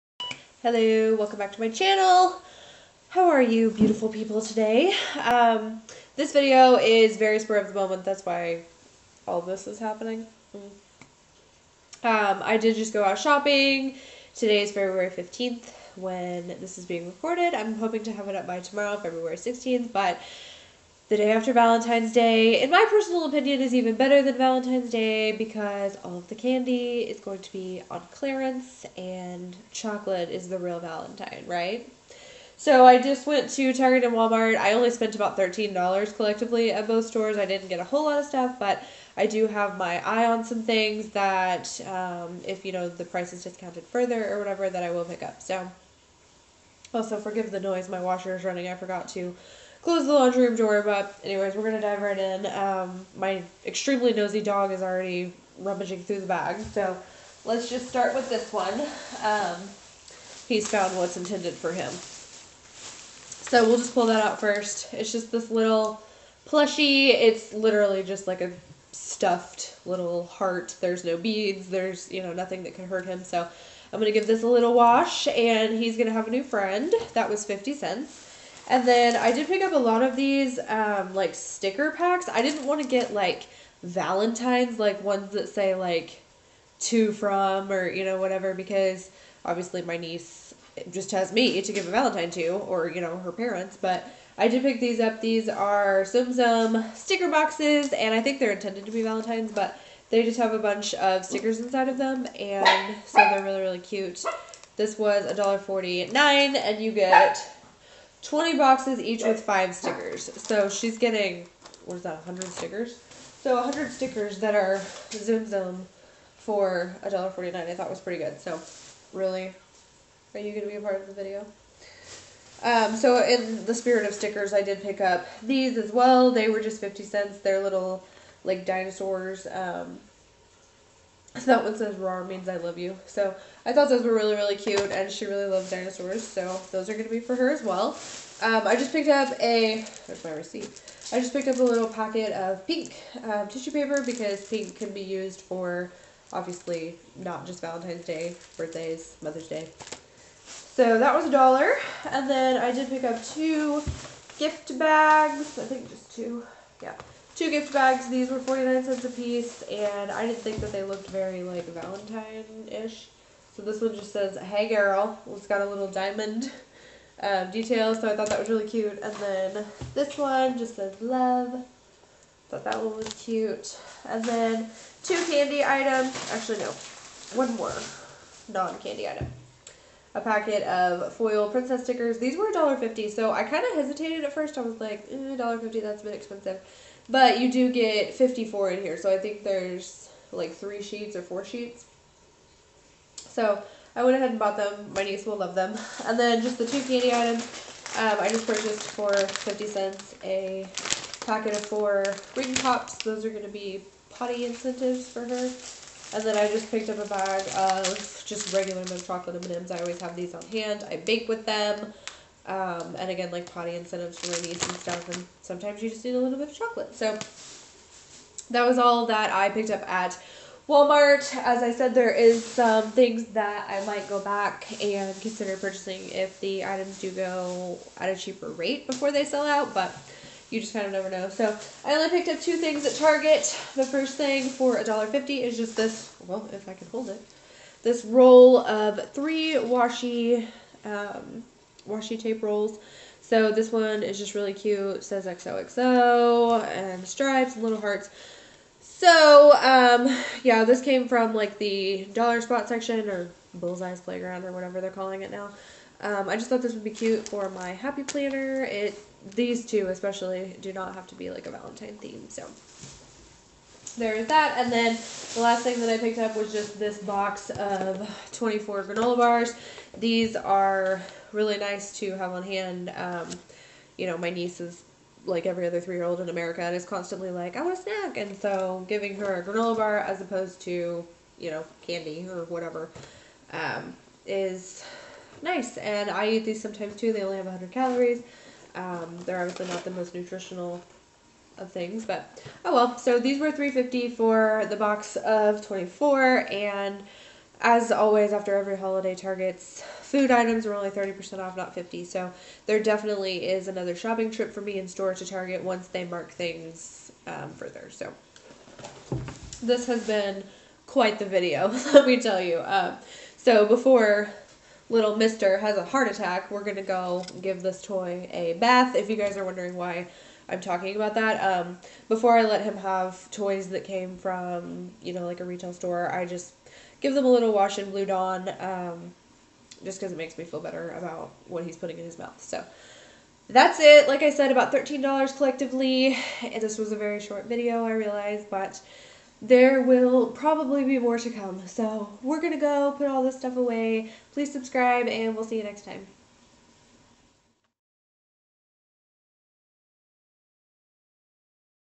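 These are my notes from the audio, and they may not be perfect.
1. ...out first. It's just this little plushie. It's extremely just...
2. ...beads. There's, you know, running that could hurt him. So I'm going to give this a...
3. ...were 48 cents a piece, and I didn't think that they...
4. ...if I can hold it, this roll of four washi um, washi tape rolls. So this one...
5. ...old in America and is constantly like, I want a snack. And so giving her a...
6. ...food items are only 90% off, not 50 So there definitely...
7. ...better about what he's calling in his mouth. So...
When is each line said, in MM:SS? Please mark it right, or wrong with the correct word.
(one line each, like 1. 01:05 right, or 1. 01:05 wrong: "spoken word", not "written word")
1. 01:04 wrong: "literally", not "extremely"
2. 01:11 wrong: "nothing", not "running"
3. 02:38 wrong: "49", not "48"
4. 03:56 wrong: "three", not "four"
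5. 04:36 right
6. 05:00 wrong: "30", not "90"
7. 05:30 wrong: "putting", not "calling".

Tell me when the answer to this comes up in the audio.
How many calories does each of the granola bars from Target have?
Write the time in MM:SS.
04:47.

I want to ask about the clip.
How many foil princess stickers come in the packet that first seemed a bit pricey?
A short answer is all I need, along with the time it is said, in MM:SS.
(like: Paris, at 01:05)
54, at 03:08.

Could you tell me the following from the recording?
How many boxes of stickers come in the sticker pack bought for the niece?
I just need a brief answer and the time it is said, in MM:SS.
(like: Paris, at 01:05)
20, at 01:48.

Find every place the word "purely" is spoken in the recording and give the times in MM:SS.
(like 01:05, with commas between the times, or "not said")
not said.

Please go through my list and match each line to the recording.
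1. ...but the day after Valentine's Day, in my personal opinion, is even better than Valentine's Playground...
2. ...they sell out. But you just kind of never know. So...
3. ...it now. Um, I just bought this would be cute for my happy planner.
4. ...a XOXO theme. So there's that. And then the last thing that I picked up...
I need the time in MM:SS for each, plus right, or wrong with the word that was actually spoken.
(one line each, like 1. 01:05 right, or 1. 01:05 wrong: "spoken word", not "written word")
1. 00:19 wrong: "Day", not "Playground"
2. 03:49 right
3. 04:15 wrong: "thought", not "bought"
4. 04:21 wrong: "Valentine", not "XOXO".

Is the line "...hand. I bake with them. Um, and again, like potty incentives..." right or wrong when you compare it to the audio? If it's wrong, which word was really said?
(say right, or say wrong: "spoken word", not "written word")
right.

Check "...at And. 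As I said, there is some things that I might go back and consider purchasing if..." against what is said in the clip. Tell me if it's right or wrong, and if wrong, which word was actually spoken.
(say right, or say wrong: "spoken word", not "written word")
wrong: "Walmart", not "And".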